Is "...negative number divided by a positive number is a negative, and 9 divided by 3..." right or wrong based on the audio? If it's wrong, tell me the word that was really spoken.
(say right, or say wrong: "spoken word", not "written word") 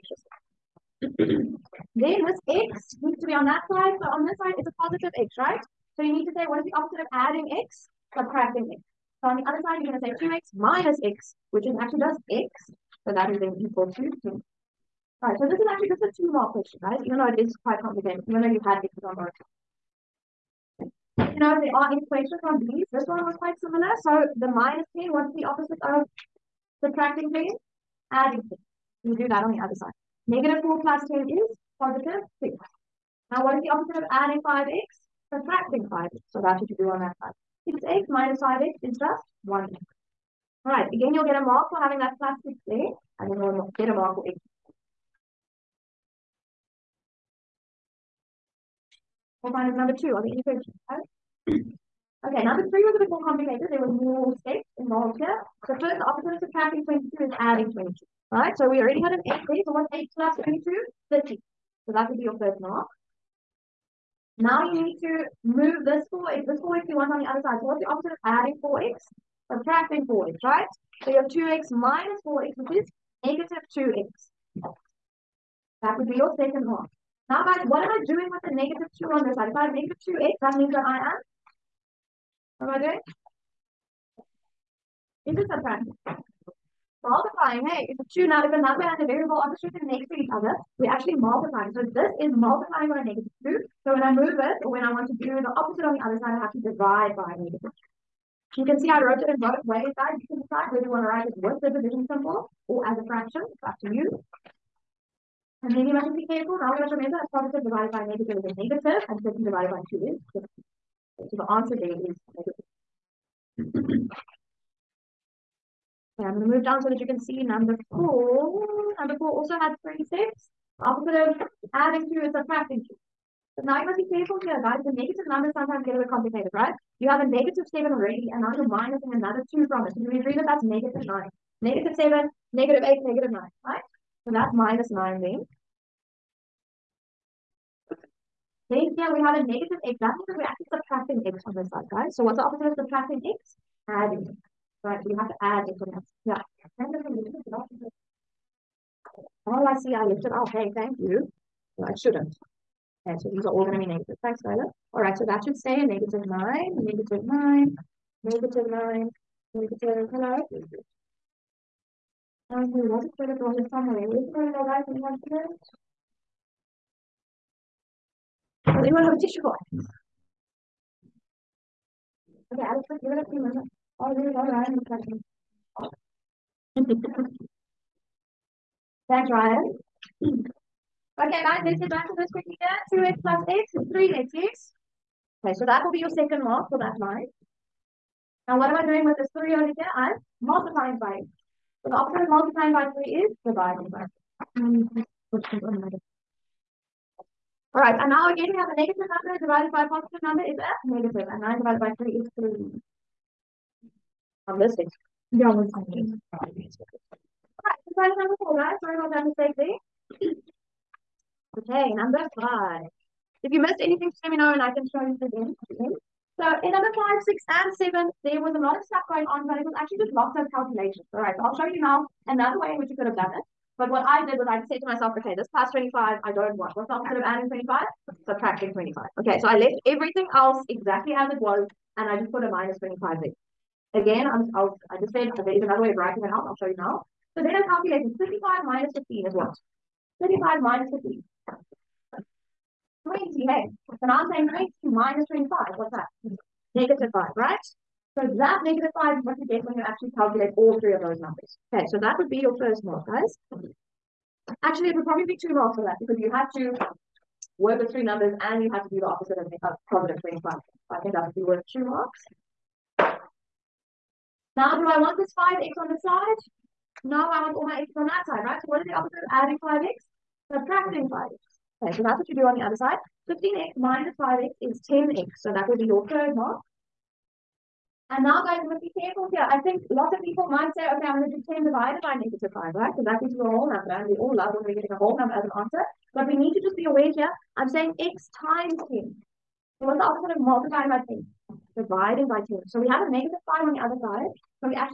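right.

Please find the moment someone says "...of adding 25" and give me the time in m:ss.
3:47.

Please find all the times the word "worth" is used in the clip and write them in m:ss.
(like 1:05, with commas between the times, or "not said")
4:21.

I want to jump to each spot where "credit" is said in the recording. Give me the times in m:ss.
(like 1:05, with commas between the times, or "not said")
2:43.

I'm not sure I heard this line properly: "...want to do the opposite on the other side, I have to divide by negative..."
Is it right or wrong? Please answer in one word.
right.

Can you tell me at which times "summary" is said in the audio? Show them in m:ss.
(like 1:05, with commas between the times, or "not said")
2:43.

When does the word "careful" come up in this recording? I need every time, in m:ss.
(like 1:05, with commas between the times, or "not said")
2:04, 4:38.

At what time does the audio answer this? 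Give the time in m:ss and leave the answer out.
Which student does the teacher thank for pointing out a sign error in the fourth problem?
2:34.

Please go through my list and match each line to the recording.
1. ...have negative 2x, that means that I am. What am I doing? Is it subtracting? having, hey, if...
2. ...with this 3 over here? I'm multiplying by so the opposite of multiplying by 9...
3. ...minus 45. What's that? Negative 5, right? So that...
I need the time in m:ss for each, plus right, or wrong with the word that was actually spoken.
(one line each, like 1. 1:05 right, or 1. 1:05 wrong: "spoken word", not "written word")
1. 1:19 wrong: "multiplying", not "having"
2. 3:09 wrong: "3", not "9"
3. 4:04 wrong: "25", not "45".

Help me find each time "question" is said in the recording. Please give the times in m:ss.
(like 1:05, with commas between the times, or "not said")
0:16, 0:22.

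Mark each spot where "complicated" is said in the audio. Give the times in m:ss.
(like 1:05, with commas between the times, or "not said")
0:17, 0:53, 2:06.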